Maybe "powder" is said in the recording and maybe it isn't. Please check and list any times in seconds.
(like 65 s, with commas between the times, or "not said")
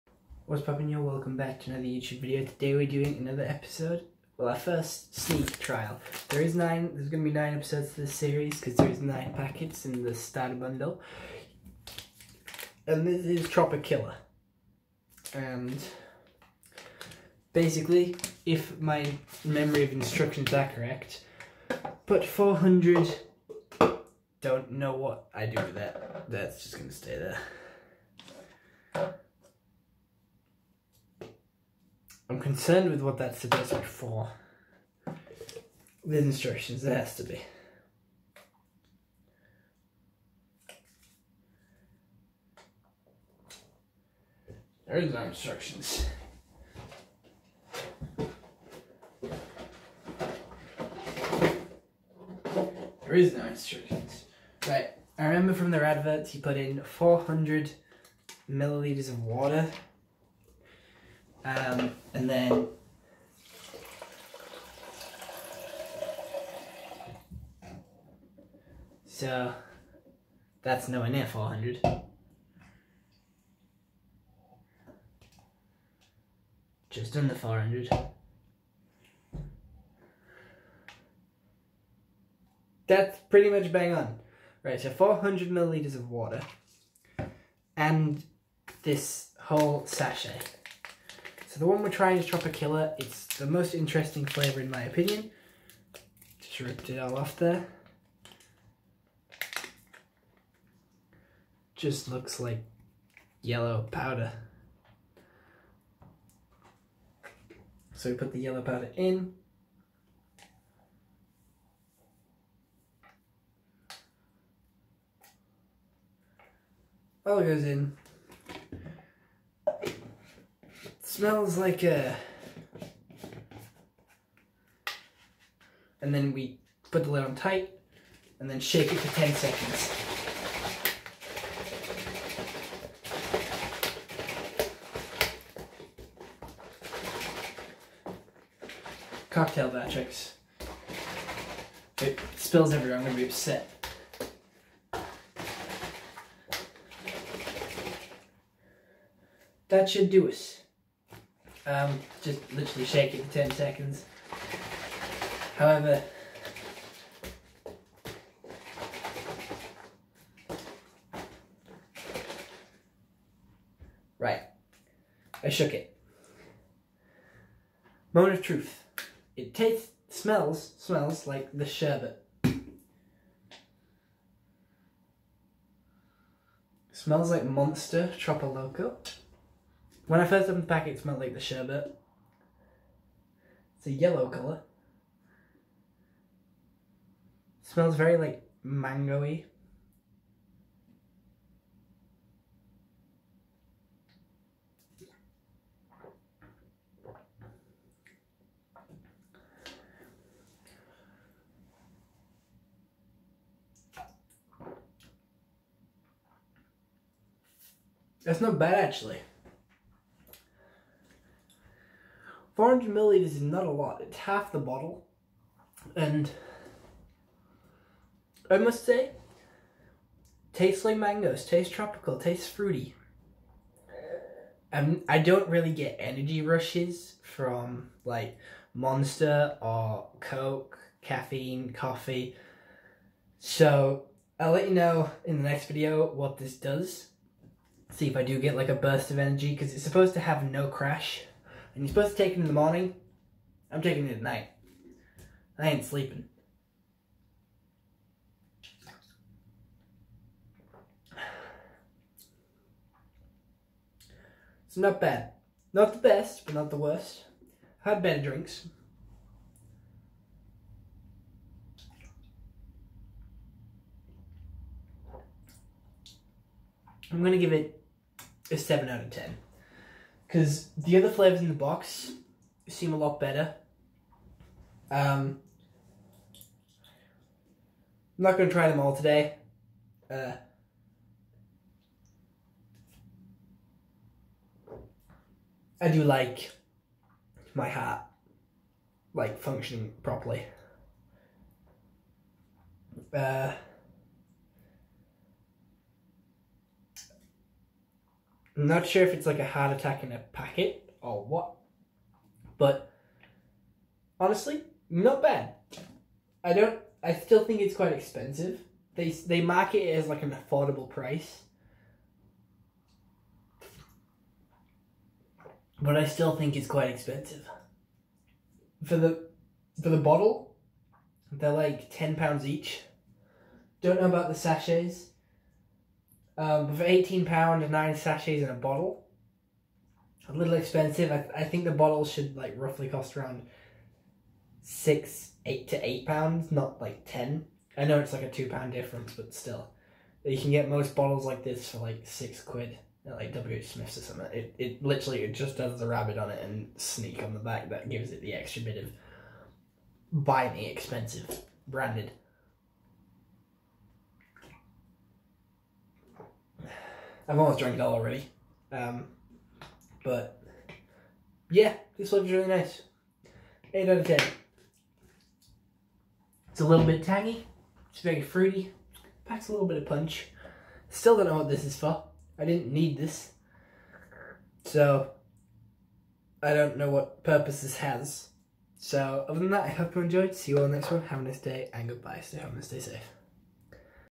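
103 s, 108 s.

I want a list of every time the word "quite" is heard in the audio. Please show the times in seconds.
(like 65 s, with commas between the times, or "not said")
307 s, 316 s.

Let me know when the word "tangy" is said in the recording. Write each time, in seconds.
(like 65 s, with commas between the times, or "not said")
367 s.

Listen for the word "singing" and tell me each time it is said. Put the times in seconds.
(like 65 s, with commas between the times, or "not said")
not said.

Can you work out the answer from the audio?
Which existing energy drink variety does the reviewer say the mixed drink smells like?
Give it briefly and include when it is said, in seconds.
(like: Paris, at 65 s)
Monster Chocolate Loco, at 177 s.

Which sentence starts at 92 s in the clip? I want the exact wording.
It's the most interesting flavour in my opinion.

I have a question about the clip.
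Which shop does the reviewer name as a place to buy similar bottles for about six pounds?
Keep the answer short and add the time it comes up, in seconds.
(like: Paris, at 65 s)
W. Smith's, at 343 s.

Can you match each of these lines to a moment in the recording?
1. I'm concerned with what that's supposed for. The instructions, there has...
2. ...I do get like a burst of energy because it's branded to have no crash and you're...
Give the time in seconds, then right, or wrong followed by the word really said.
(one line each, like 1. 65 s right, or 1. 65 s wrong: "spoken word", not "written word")
1. 32 s right
2. 238 s wrong: "supposed", not "branded".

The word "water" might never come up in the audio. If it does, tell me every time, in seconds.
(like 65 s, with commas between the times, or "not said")
59 s, 86 s.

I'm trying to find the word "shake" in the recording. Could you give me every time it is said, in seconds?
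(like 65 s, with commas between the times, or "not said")
128 s, 152 s.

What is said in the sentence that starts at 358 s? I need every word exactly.
Um, but yeah, this one's really nice.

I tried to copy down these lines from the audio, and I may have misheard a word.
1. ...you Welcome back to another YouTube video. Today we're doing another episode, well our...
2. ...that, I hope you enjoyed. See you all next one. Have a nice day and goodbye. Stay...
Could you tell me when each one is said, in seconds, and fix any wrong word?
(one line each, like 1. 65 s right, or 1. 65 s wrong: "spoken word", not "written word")
1. 0 s right
2. 379 s right.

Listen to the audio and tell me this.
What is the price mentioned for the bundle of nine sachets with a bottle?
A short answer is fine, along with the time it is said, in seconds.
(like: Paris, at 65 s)
£18, at 326 s.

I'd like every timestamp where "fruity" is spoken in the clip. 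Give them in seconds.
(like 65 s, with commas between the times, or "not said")
222 s, 368 s.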